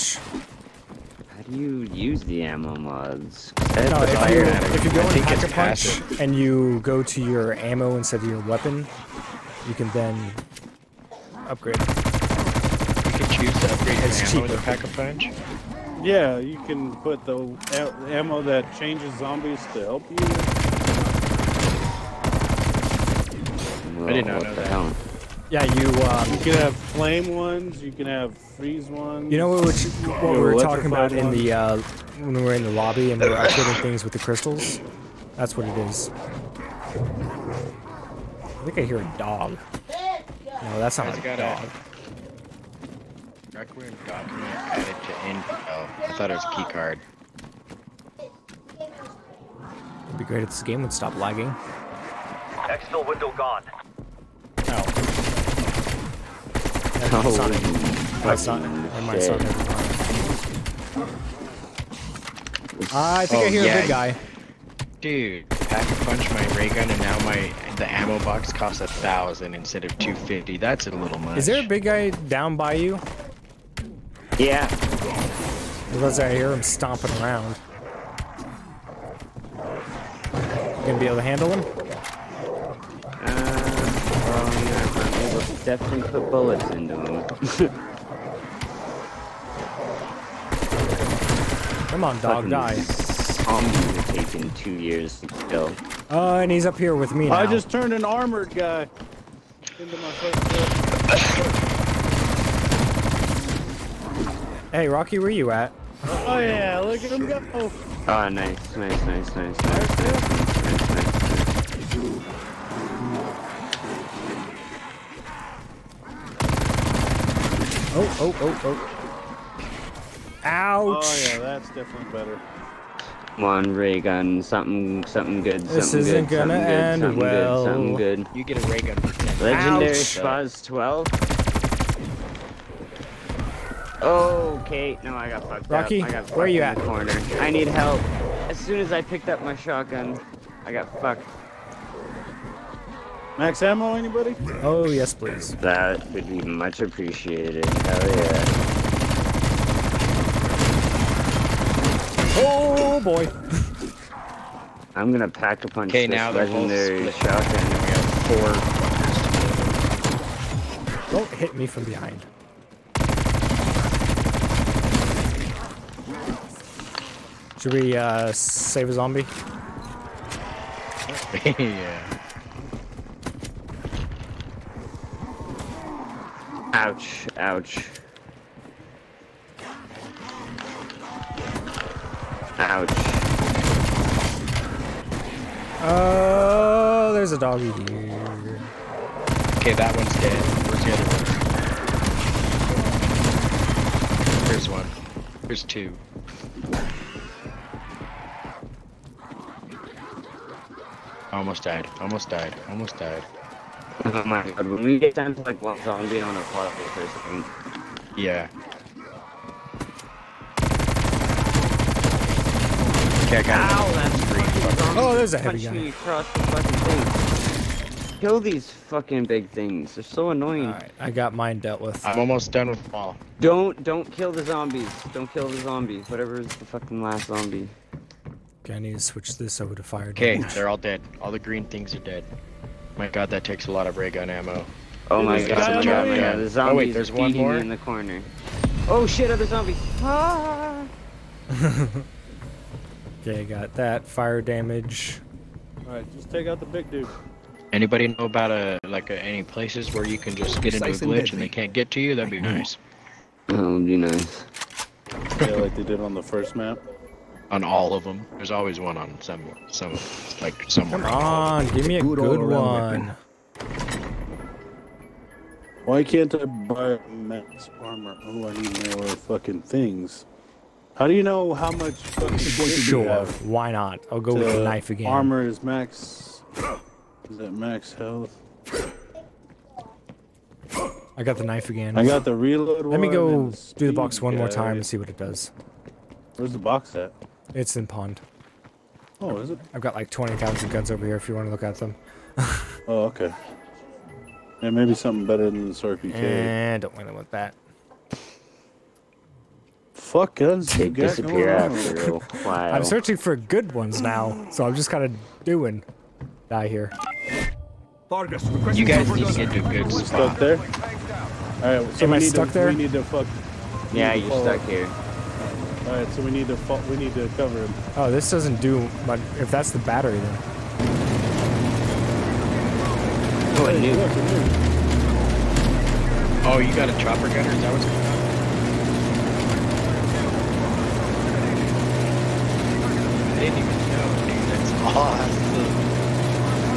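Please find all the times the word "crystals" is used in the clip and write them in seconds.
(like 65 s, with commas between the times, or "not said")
34 s.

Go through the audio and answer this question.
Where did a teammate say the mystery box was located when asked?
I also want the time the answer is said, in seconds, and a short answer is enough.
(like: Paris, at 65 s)
pond, at 287 s.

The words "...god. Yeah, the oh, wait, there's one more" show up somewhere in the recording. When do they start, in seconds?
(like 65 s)
235 s.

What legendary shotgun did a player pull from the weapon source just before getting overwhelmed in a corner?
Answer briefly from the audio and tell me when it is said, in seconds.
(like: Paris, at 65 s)
Spaz 12, at 129 s.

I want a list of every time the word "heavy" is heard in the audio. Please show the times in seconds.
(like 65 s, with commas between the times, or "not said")
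215 s.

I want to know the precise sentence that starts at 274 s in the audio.
I'll go with the knife again.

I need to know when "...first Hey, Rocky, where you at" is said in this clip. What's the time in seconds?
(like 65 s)
100 s.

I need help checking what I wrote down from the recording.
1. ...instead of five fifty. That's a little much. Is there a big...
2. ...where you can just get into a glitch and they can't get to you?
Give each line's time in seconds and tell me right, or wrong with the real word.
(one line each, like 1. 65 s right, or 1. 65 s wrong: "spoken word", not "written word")
1. 69 s wrong: "two", not "five"
2. 249 s right.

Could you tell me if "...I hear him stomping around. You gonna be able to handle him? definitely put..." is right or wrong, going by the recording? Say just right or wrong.
right.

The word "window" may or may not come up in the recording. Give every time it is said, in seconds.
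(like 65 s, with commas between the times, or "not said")
53 s.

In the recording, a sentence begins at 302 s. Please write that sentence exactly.
I'm searching for good ones now, so I'm just kind of doing.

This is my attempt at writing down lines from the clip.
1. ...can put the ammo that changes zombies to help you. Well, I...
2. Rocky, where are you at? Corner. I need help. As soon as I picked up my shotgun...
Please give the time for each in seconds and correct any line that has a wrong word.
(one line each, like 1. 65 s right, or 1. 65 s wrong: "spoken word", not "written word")
1. 16 s right
2. 136 s right.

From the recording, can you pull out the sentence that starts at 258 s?
There's always one on some, some, like someone.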